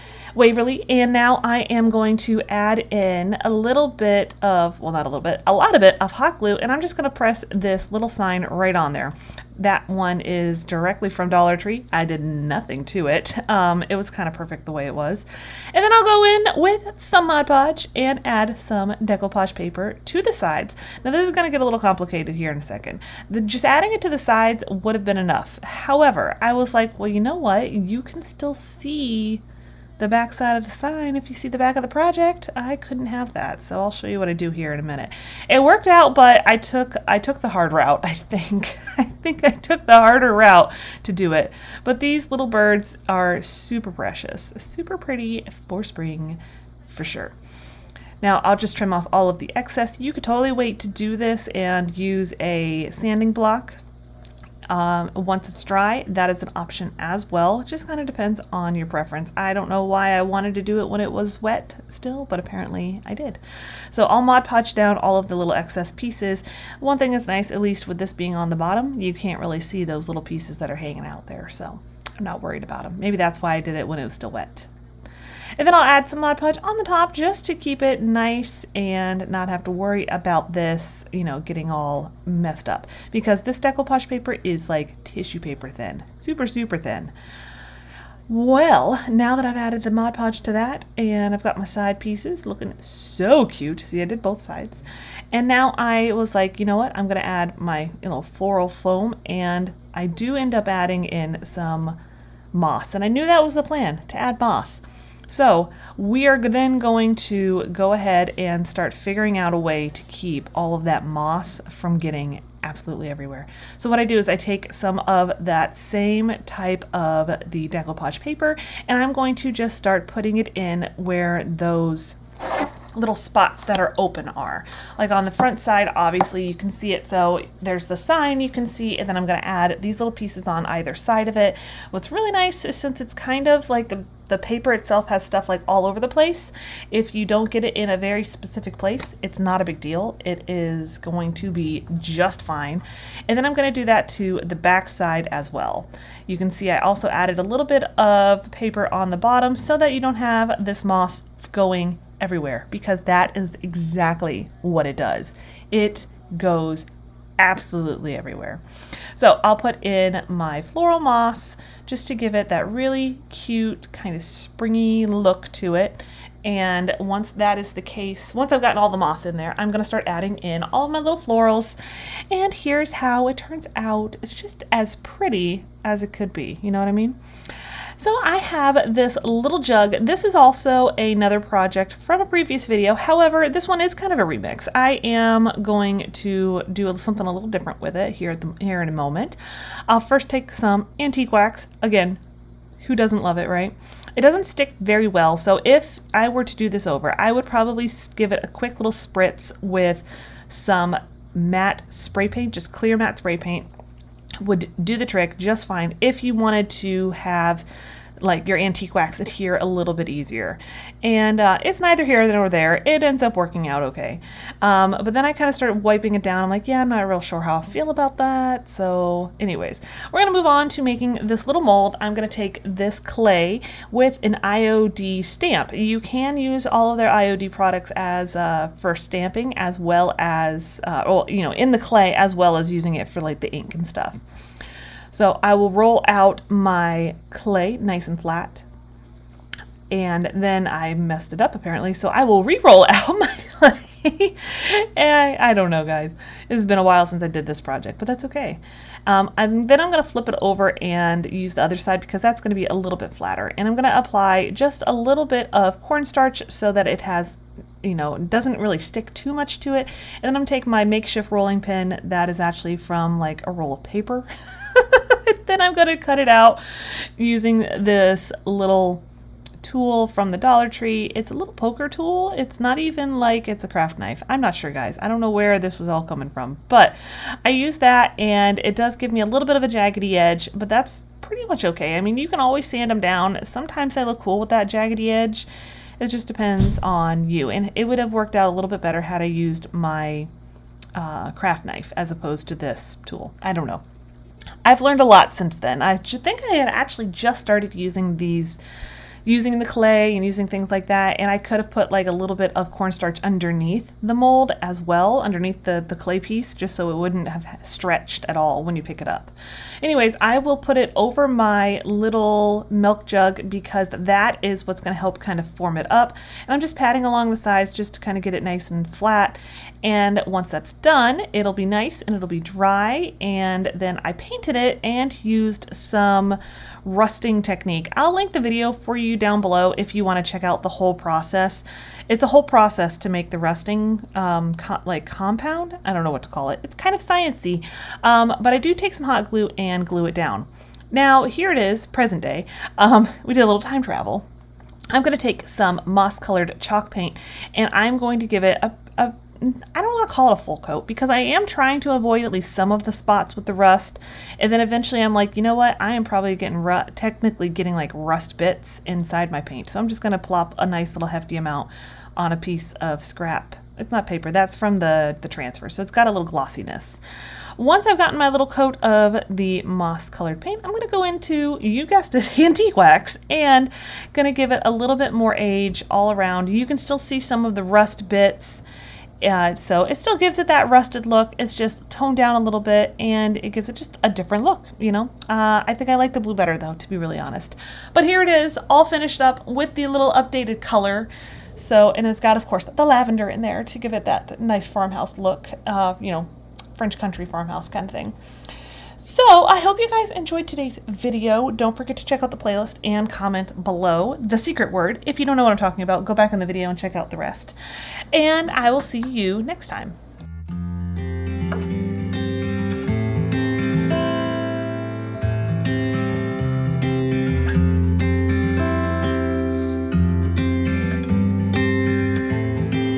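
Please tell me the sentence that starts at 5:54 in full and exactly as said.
And then eventually I'm like, you know what?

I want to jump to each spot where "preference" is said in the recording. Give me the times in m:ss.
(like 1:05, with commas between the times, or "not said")
0:58.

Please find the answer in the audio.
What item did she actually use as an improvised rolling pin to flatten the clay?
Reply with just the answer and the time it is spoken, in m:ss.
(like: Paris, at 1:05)
a roll of paper, at 4:23.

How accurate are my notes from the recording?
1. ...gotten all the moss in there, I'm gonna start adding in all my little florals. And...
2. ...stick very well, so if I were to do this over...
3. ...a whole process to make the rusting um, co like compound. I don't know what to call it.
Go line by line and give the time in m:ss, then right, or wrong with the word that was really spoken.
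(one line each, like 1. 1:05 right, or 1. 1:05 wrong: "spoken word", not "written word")
1. 2:48 right
2. 3:14 right
3. 5:32 right.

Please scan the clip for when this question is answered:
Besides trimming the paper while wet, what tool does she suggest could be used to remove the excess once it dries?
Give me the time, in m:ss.
0:52.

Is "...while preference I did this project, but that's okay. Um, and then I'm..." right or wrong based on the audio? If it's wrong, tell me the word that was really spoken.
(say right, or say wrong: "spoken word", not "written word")
wrong: "since", not "preference".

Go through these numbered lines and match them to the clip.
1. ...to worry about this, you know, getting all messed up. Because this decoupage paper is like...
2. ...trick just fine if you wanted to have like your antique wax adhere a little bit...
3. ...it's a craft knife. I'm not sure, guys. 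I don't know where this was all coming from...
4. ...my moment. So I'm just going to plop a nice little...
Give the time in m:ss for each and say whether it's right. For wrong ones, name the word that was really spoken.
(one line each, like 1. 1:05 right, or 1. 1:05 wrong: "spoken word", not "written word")
1. 1:19 right
2. 3:25 right
3. 4:33 right
4. 5:59 wrong: "paint", not "moment".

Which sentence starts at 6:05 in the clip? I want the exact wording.
So it's got a little glossiness.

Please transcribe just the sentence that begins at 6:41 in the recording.
Don't forget to check out the playlist and comment below the secret word.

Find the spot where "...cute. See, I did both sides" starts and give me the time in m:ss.
1:33.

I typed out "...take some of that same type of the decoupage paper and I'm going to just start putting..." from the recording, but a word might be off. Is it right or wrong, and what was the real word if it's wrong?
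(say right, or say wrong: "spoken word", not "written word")
right.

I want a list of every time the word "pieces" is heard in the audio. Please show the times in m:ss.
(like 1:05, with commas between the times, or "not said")
1:05, 1:10, 1:31, 2:10, 5:06, 6:02.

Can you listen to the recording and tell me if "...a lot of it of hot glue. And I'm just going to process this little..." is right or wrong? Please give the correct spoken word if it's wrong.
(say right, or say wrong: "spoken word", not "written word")
wrong: "press", not "process".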